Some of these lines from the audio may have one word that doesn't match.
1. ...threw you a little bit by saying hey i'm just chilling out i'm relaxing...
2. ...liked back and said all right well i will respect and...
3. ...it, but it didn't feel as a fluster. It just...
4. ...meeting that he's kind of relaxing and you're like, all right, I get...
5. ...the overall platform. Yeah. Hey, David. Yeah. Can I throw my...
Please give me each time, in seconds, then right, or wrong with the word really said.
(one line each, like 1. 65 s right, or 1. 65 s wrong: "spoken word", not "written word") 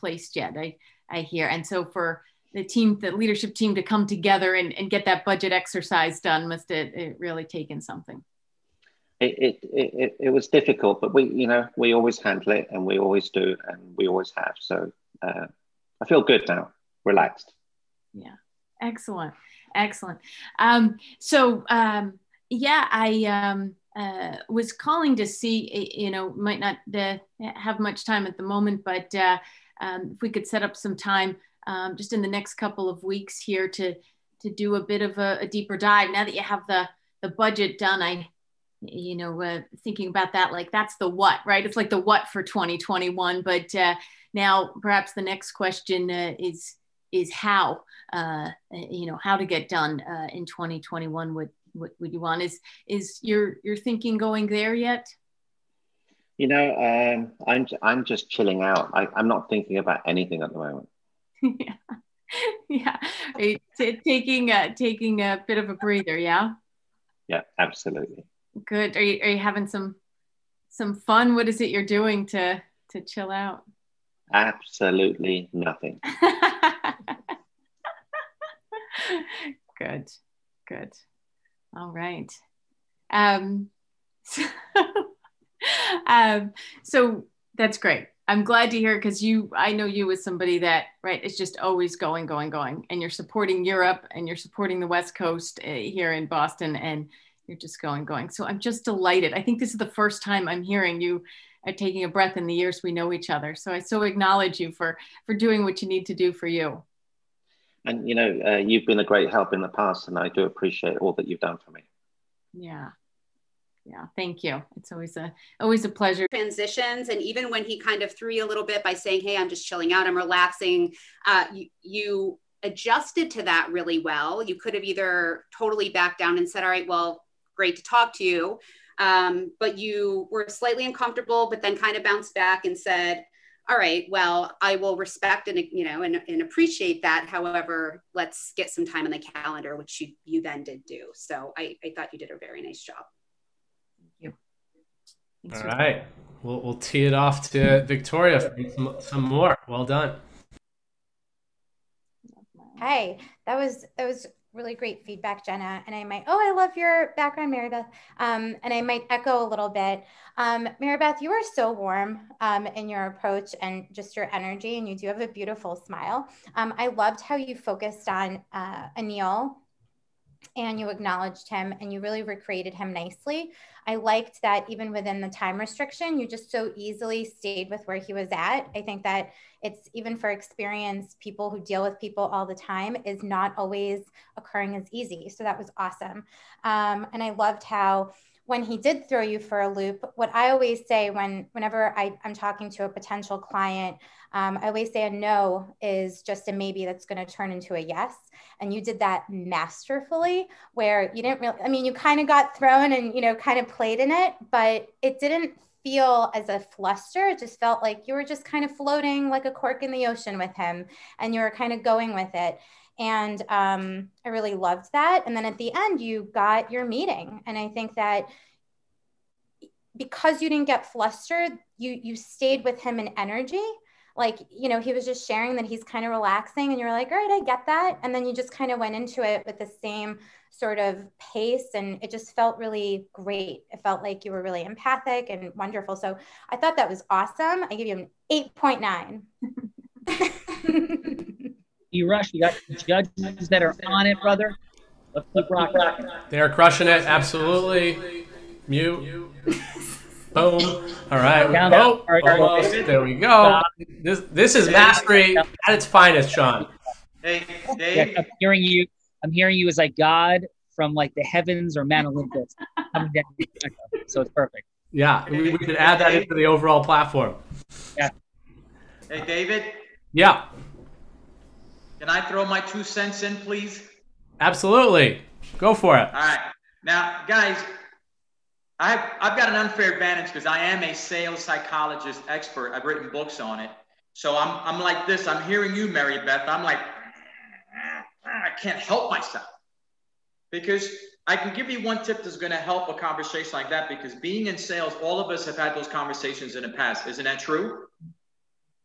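1. 118 s right
2. 132 s wrong: "bounced", not "liked"
3. 204 s right
4. 225 s wrong: "sharing", not "meeting"
5. 266 s right.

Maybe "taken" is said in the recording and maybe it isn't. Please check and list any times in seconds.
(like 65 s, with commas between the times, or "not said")
7 s.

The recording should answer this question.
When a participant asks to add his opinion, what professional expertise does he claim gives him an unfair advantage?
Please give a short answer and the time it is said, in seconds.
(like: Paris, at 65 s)
sales psychologist expert, at 280 s.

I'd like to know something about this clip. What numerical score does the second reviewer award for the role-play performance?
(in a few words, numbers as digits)
8.9.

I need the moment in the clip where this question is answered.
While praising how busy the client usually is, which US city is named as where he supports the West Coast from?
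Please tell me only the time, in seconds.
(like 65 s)
96 s.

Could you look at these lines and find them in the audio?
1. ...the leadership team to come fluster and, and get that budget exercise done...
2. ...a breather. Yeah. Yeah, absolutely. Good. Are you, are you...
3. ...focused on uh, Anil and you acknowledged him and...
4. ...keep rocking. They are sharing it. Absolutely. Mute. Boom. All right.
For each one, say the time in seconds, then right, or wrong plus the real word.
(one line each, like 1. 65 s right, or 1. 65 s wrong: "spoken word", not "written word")
1. 2 s wrong: "together", not "fluster"
2. 65 s right
3. 167 s right
4. 245 s wrong: "crushing", not "sharing".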